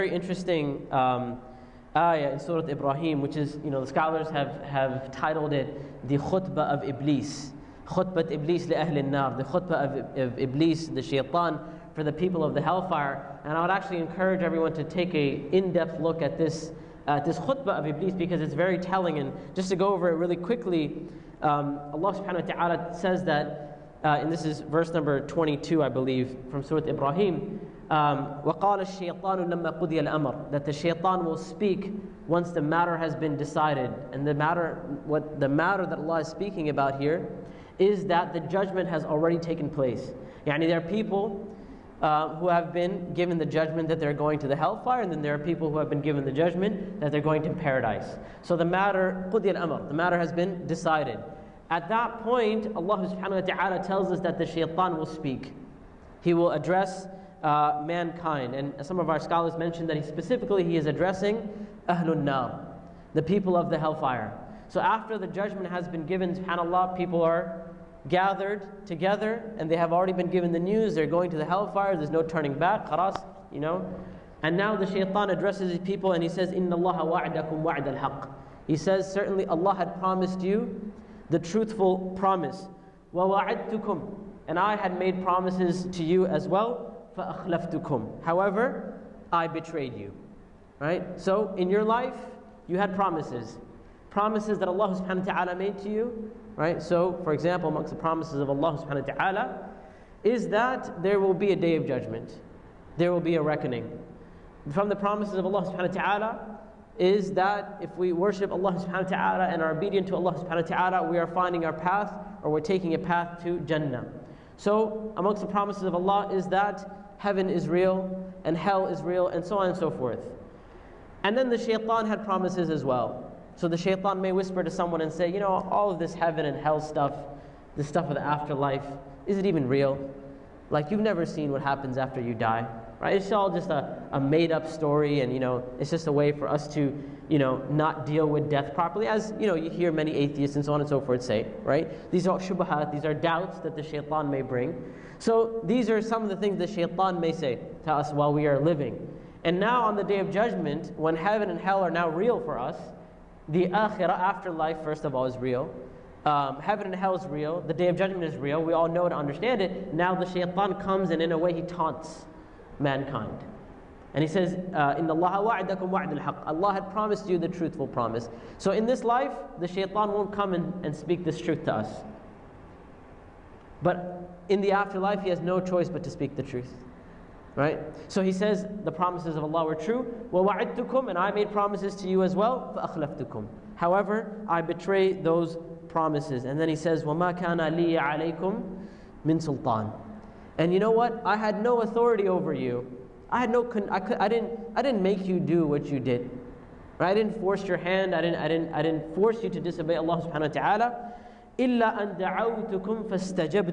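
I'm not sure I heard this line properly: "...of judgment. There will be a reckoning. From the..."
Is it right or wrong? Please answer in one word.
right.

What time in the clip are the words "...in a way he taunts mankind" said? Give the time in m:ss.
2:41.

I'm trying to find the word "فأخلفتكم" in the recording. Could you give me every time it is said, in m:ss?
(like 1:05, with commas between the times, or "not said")
1:27, 3:02.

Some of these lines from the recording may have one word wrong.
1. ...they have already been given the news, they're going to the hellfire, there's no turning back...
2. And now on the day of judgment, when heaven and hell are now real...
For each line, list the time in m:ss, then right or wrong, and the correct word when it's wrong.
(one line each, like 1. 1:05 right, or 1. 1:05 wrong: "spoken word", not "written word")
1. 1:09 right
2. 2:29 right.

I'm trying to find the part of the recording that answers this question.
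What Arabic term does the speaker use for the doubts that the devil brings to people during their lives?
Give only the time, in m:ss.
2:22.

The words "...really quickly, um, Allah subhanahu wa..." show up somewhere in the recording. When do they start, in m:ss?
0:20.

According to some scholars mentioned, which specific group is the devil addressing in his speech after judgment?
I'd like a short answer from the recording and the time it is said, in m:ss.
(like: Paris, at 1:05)
Ahlun Nar, at 1:01.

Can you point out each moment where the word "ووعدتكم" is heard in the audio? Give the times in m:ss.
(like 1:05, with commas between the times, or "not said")
1:23, 3:00.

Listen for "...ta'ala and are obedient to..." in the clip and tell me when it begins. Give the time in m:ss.
1:49.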